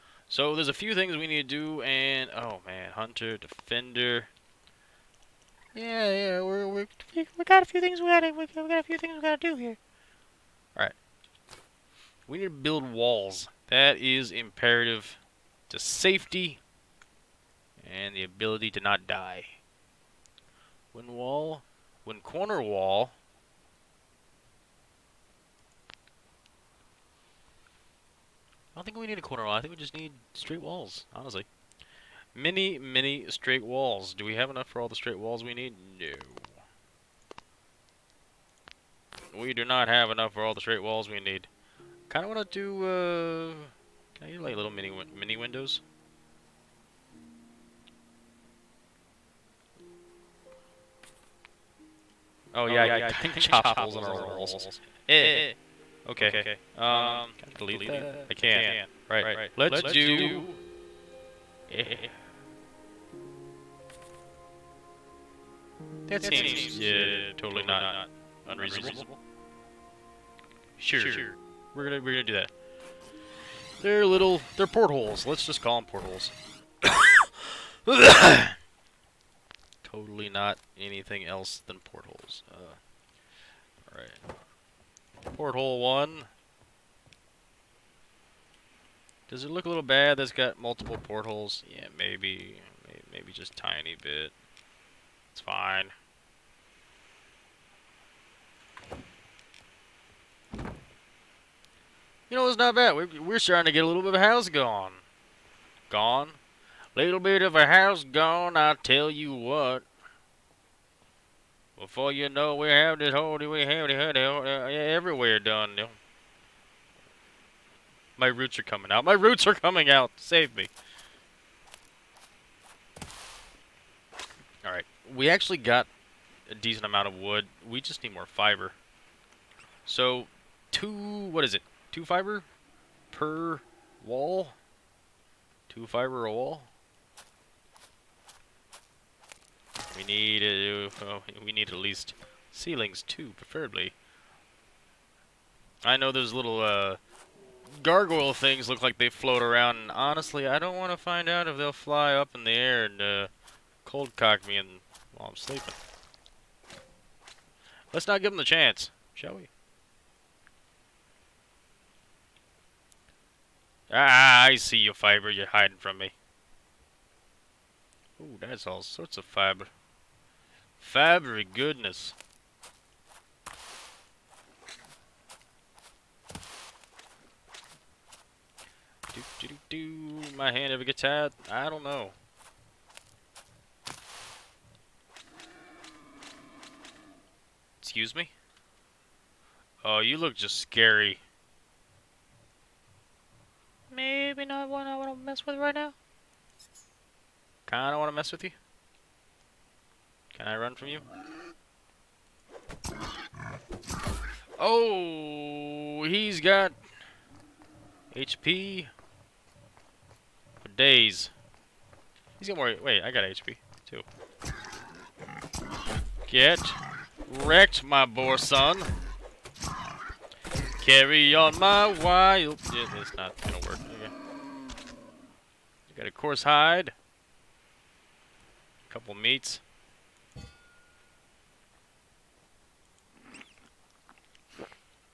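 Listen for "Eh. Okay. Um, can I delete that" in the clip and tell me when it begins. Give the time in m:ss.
0:55.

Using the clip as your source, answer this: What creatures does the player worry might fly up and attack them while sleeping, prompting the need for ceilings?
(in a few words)
gargoyle things.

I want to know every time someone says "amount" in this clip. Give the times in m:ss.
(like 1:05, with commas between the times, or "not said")
2:06.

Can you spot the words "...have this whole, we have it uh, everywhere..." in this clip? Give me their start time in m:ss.
1:52.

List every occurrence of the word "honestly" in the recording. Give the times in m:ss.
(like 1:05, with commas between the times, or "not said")
0:31, 2:29.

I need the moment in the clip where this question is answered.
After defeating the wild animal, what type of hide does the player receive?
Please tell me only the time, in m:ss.
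3:46.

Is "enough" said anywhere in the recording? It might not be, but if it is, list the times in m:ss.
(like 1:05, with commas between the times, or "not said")
0:34, 0:40.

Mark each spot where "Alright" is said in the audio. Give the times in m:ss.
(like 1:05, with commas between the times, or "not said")
1:23, 2:04.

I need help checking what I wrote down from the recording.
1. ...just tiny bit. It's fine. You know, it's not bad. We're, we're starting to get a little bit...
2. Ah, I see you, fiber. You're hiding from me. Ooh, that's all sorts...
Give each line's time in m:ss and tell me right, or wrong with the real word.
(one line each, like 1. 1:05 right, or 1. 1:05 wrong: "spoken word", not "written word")
1. 1:33 right
2. 2:43 right.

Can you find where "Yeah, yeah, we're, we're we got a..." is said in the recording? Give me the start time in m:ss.
0:05.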